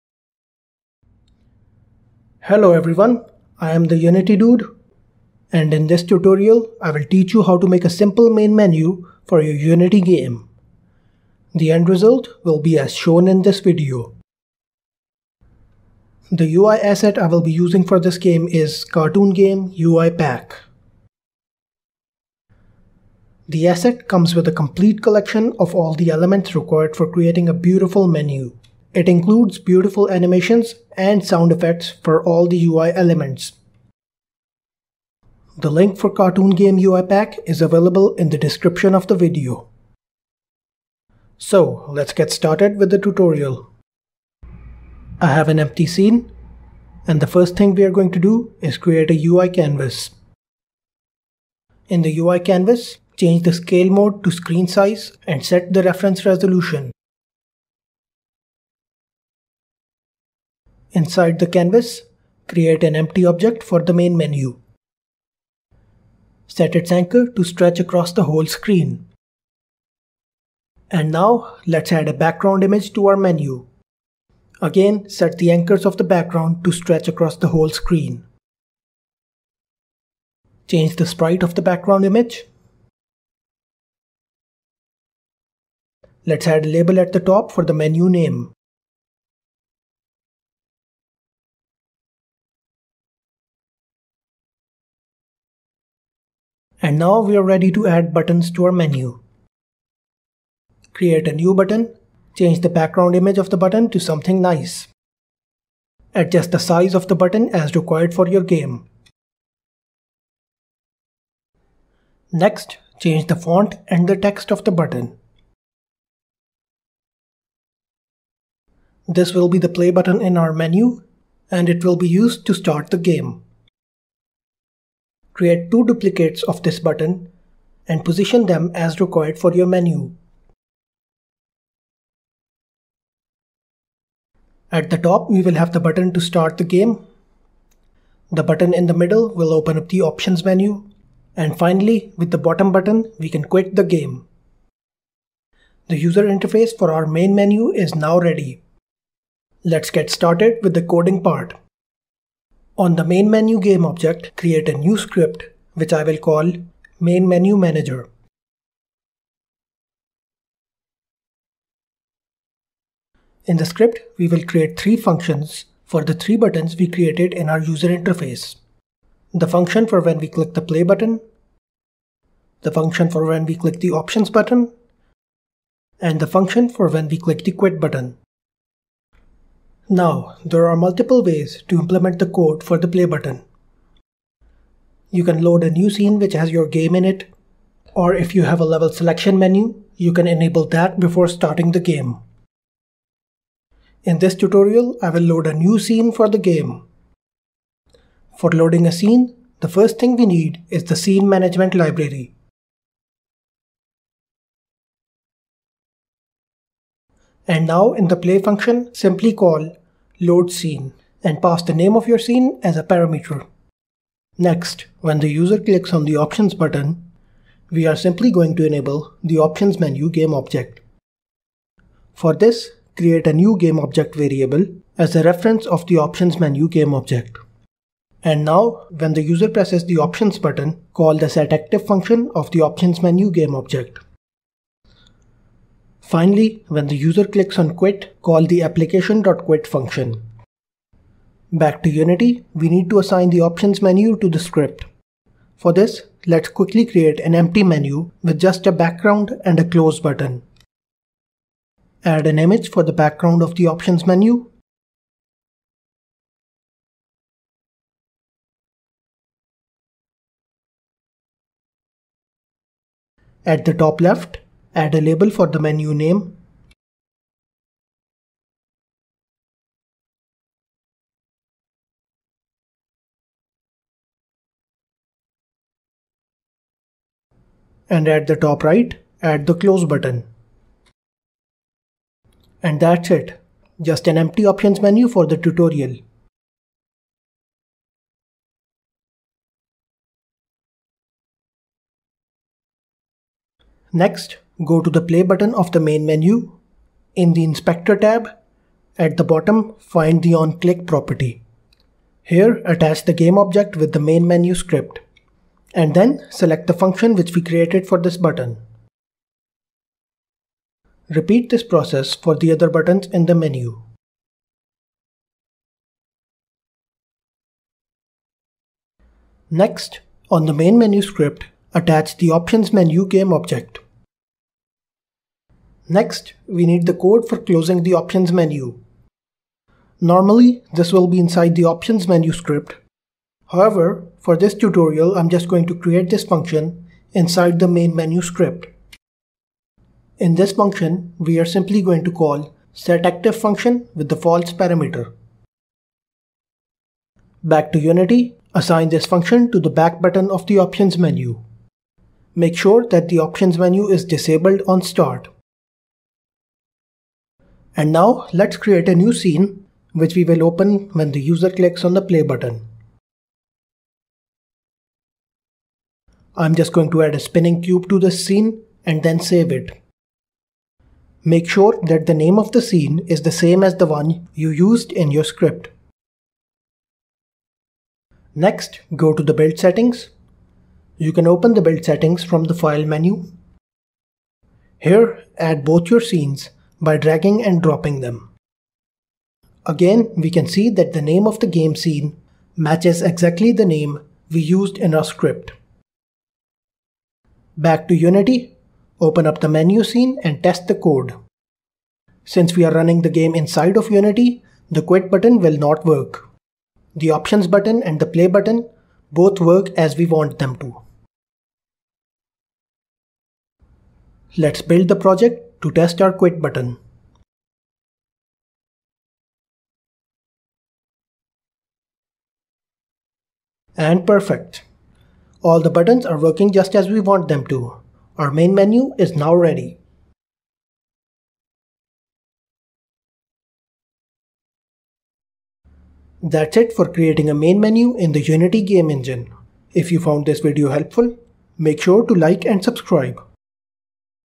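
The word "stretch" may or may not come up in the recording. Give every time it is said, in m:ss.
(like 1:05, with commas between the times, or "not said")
1:07, 1:16.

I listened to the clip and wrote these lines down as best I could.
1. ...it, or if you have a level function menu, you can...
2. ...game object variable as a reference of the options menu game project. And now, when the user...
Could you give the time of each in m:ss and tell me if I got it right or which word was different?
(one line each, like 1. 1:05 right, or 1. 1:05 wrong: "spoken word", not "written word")
1. 3:07 wrong: "selection", not "function"
2. 3:43 wrong: "object", not "project".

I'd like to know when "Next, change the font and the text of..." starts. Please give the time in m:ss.
1:52.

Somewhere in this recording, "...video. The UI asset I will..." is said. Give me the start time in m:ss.
0:13.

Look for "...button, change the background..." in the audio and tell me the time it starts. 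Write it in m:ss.
1:41.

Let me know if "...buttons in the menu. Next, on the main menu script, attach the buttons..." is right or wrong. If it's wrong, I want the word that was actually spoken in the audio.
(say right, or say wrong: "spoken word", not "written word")
wrong: "options", not "buttons".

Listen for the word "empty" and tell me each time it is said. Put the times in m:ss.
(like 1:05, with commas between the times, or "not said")
0:45, 1:02, 4:07, 4:44.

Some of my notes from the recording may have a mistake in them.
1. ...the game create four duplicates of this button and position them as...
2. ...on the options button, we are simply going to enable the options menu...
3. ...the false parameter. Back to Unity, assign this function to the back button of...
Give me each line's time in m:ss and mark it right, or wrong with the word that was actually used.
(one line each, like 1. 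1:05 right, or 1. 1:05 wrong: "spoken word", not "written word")
1. 2:02 wrong: "two", not "four"
2. 3:35 right
3. 5:44 right.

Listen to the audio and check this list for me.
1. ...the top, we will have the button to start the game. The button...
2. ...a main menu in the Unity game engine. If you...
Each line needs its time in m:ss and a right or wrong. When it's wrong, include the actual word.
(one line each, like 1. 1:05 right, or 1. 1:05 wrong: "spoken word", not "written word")
1. 2:14 right
2. 7:17 right.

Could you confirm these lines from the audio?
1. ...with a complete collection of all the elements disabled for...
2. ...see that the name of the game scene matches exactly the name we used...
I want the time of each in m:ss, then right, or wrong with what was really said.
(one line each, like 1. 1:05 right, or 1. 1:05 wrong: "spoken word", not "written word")
1. 0:24 wrong: "required", not "disabled"
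2. 6:30 right.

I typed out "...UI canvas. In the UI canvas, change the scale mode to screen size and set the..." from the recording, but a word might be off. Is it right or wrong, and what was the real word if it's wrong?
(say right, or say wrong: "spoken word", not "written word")
right.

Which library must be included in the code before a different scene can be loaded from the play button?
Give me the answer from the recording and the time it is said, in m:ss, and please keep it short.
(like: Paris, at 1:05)
Scene Management Library, at 3:20.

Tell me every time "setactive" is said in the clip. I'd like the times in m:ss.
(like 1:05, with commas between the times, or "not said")
3:51, 5:42.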